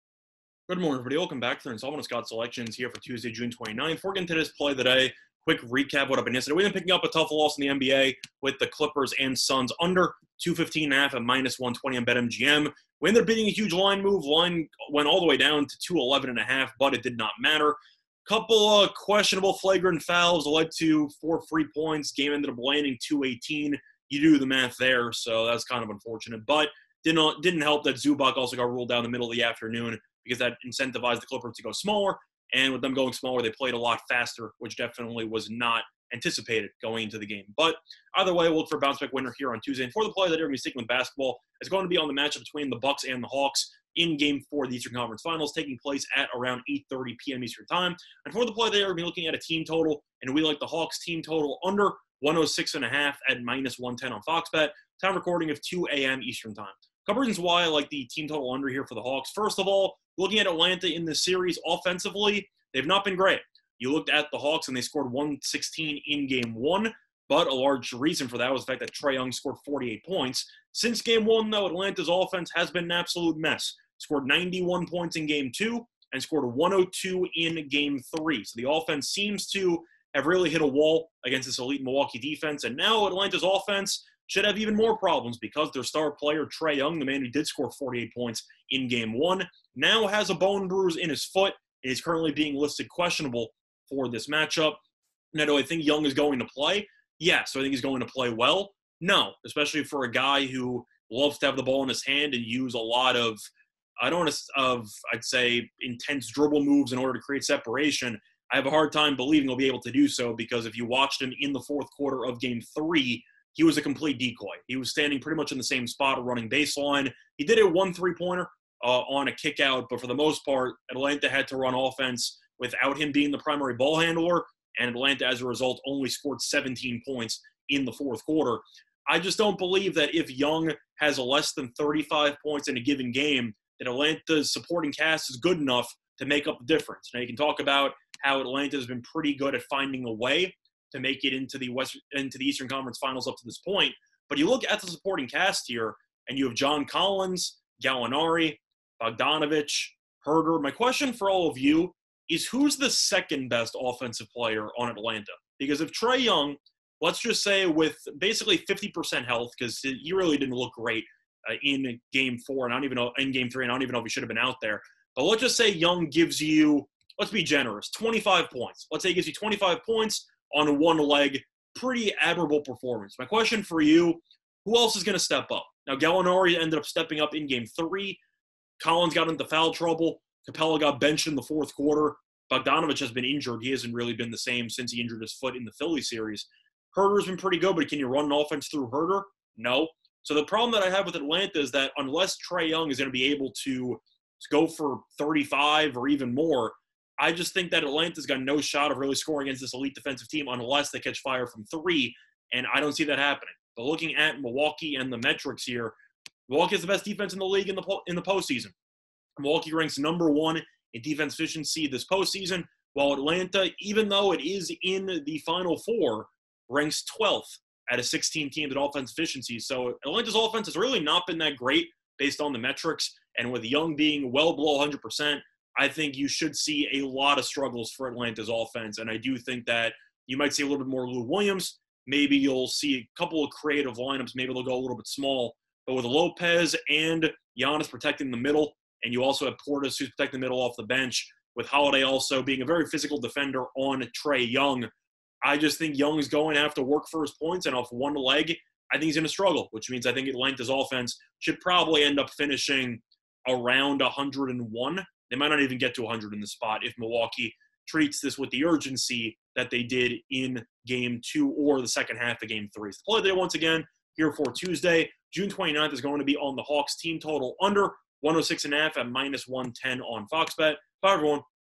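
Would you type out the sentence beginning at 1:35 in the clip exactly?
Now, do I think Young is going to play?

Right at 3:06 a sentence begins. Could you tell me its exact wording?
Huerter's been pretty good, but can you run an offense through Huerter?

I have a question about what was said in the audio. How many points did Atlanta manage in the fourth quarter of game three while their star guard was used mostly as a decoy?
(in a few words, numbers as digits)
17.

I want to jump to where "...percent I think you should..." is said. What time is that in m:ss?
3:45.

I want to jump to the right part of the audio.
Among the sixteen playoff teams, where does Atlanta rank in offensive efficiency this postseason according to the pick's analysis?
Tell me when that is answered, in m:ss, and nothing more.
3:37.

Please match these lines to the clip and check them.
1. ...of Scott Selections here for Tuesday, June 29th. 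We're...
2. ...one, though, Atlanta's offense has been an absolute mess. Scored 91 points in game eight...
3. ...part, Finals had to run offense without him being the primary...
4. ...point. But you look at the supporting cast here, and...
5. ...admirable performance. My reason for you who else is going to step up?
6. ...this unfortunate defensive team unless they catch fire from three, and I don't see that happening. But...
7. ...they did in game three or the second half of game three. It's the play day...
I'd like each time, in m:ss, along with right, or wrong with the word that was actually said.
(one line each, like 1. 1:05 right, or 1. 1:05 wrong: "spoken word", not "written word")
1. 0:01 right
2. 1:11 wrong: "two", not "eight"
3. 2:00 wrong: "Atlanta", not "Finals"
4. 2:23 right
5. 2:52 wrong: "question", not "reason"
6. 3:19 wrong: "elite", not "unfortunate"
7. 4:19 wrong: "two", not "three".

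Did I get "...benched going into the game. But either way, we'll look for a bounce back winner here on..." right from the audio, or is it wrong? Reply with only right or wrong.
wrong.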